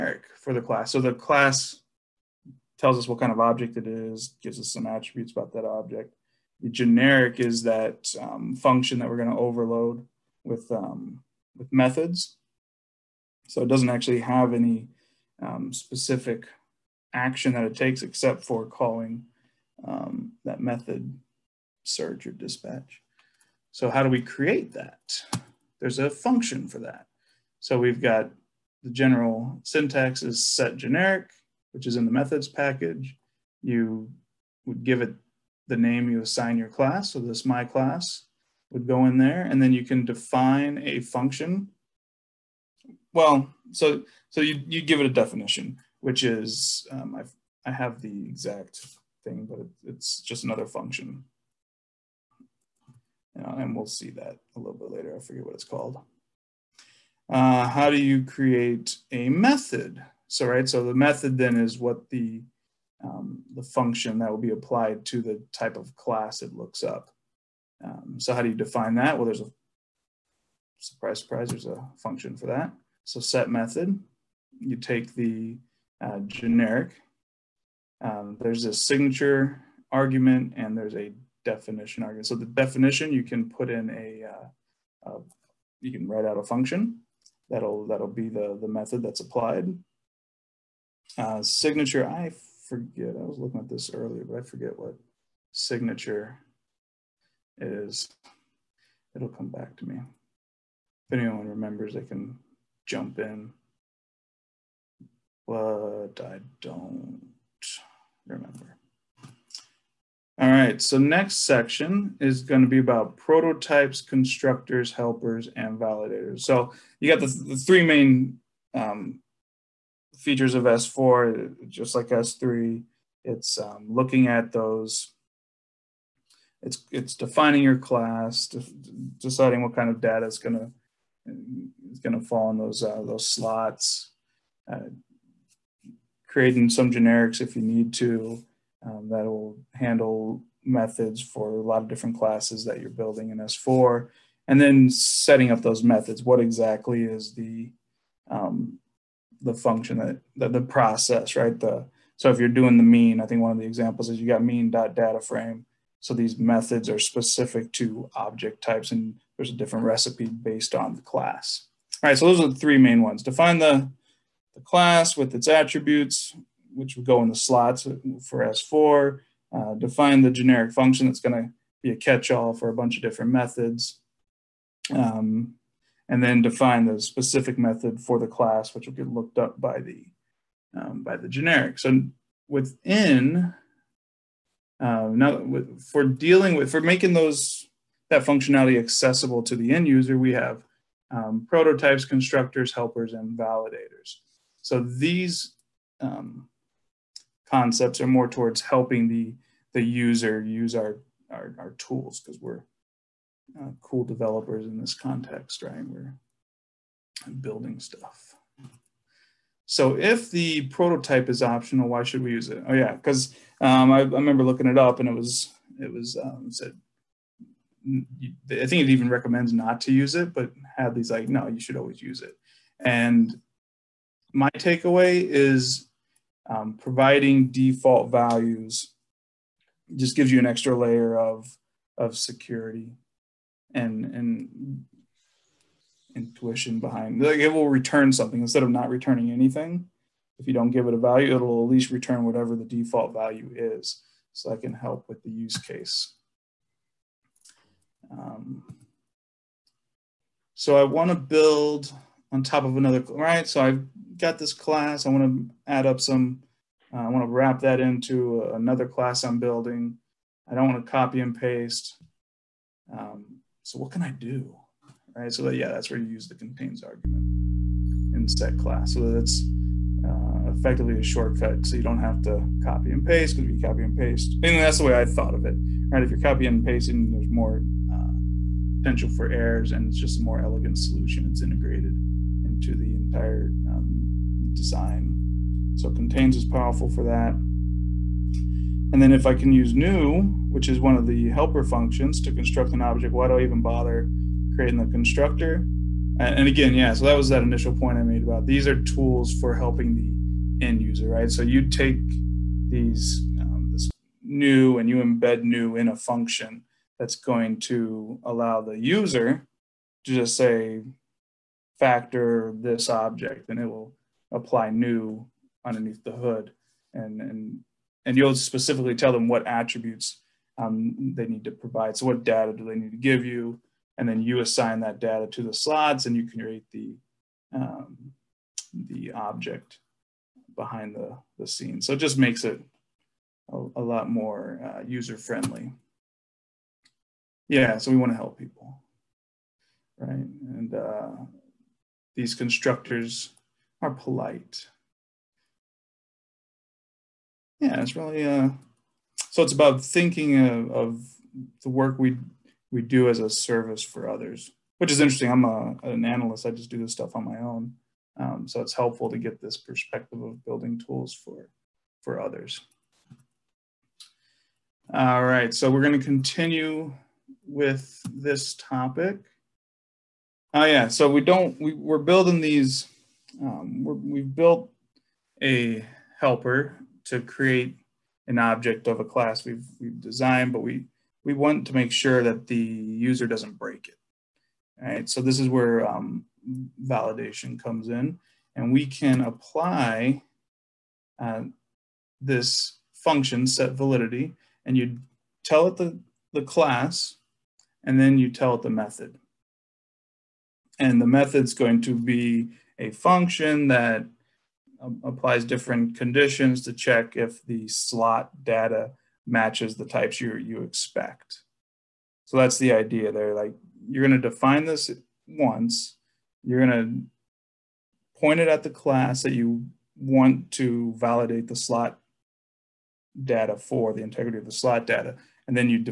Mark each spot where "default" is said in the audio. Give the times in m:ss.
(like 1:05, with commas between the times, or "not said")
3:47, 4:02.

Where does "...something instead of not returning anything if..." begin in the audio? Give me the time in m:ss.
3:58.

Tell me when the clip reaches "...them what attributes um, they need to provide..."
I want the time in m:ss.
5:19.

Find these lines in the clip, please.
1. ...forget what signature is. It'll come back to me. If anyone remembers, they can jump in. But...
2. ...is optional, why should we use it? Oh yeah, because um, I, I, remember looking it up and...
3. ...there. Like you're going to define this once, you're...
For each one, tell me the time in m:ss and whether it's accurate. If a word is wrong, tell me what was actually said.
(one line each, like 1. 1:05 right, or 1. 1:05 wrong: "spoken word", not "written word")
1. 1:34 right
2. 3:31 right
3. 6:53 right.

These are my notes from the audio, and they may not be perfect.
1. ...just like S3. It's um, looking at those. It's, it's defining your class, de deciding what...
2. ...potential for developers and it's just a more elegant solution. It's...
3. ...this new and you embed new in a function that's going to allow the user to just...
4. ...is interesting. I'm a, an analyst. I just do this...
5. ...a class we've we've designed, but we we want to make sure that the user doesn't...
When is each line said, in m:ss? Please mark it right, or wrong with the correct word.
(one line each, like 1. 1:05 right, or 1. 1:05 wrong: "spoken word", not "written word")
1. 2:01 right
2. 4:38 wrong: "errors", not "developers"
3. 5:03 right
4. 5:54 right
5. 6:18 right.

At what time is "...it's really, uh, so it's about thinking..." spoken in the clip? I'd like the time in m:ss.
5:47.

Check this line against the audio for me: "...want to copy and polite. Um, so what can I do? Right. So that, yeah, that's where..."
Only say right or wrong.
wrong.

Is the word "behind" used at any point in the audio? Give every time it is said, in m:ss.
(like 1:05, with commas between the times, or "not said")
3:56, 5:30.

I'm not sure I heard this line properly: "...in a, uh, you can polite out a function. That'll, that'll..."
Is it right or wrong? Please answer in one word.
wrong.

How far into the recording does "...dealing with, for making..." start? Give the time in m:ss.
3:06.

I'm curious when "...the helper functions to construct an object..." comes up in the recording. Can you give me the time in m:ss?
4:51.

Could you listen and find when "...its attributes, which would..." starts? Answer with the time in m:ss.
2:45.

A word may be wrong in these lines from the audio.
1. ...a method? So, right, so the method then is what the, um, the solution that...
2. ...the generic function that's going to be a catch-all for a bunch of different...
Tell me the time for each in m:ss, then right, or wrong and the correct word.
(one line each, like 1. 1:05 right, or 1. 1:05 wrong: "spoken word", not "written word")
1. 0:59 wrong: "function", not "solution"
2. 2:50 right.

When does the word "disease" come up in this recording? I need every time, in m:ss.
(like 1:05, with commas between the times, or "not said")
not said.